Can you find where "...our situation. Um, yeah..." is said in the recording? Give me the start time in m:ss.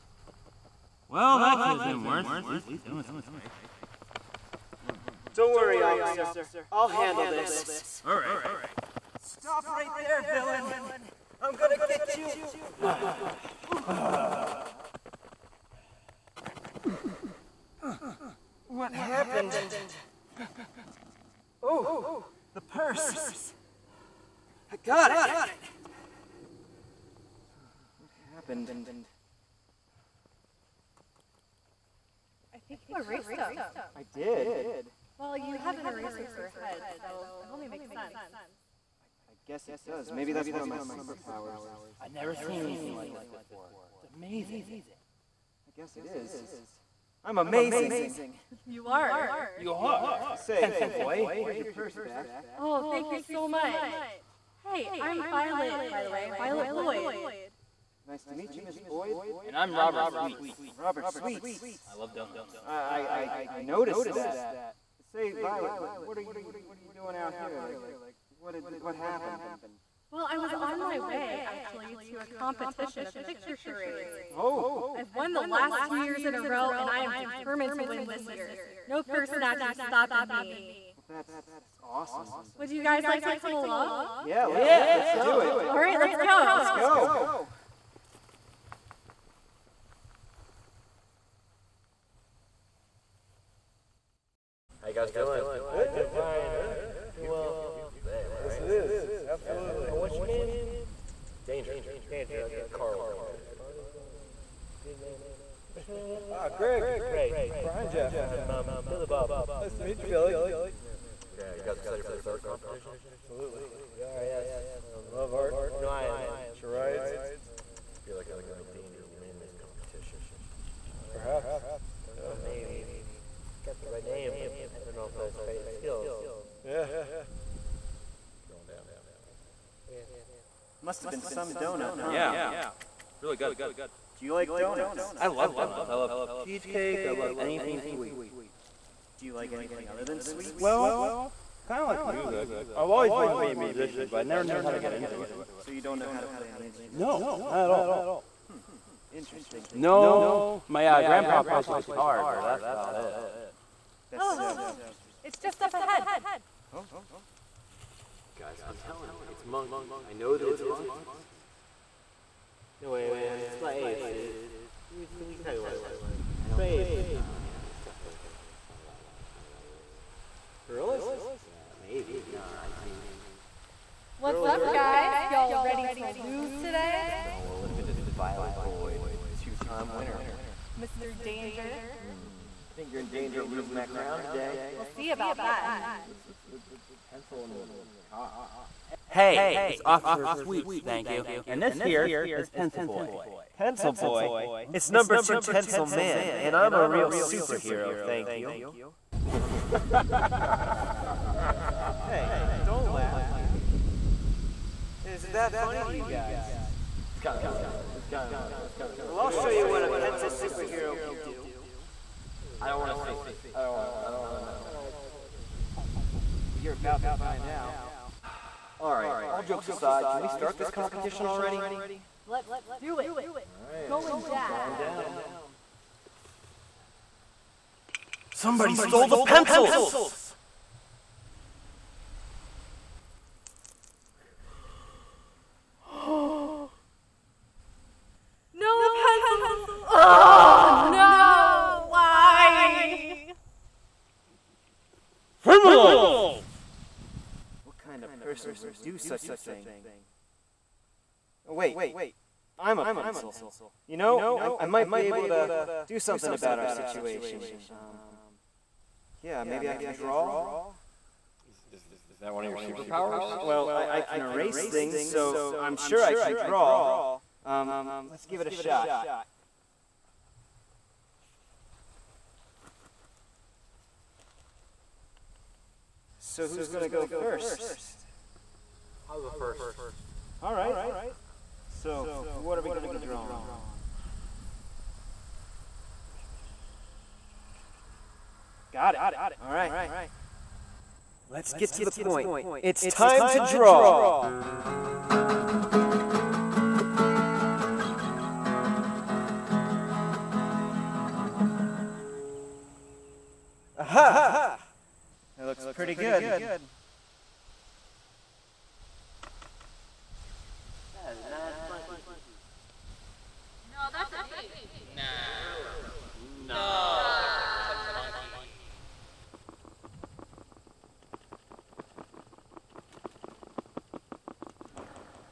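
4:16.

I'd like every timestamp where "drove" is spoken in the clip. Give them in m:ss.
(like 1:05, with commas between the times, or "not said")
not said.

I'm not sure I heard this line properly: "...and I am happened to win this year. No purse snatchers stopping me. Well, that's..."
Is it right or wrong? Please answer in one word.
wrong.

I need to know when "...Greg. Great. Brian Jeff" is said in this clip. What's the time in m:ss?
1:46.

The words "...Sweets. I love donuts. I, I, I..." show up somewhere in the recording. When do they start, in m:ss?
1:01.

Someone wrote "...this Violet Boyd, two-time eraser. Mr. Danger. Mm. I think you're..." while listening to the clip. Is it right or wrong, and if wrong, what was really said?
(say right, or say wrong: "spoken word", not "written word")
wrong: "winner", not "eraser".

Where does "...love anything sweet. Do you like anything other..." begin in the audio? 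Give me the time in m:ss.
2:17.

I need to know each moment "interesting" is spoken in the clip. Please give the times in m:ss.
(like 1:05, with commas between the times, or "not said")
2:29, 2:34.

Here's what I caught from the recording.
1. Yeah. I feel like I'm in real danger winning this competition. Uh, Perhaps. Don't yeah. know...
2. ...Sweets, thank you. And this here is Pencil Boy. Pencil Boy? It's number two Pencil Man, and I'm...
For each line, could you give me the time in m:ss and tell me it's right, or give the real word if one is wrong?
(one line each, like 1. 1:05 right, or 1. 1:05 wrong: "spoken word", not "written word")
1. 1:57 right
2. 3:10 right.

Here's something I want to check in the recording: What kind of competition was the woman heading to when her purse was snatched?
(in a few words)
picture charades.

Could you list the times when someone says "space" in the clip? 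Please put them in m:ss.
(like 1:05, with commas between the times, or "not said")
not said.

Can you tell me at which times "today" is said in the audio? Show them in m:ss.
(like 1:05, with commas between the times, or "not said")
2:56, 3:04.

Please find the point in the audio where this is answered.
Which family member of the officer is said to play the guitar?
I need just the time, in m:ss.
2:31.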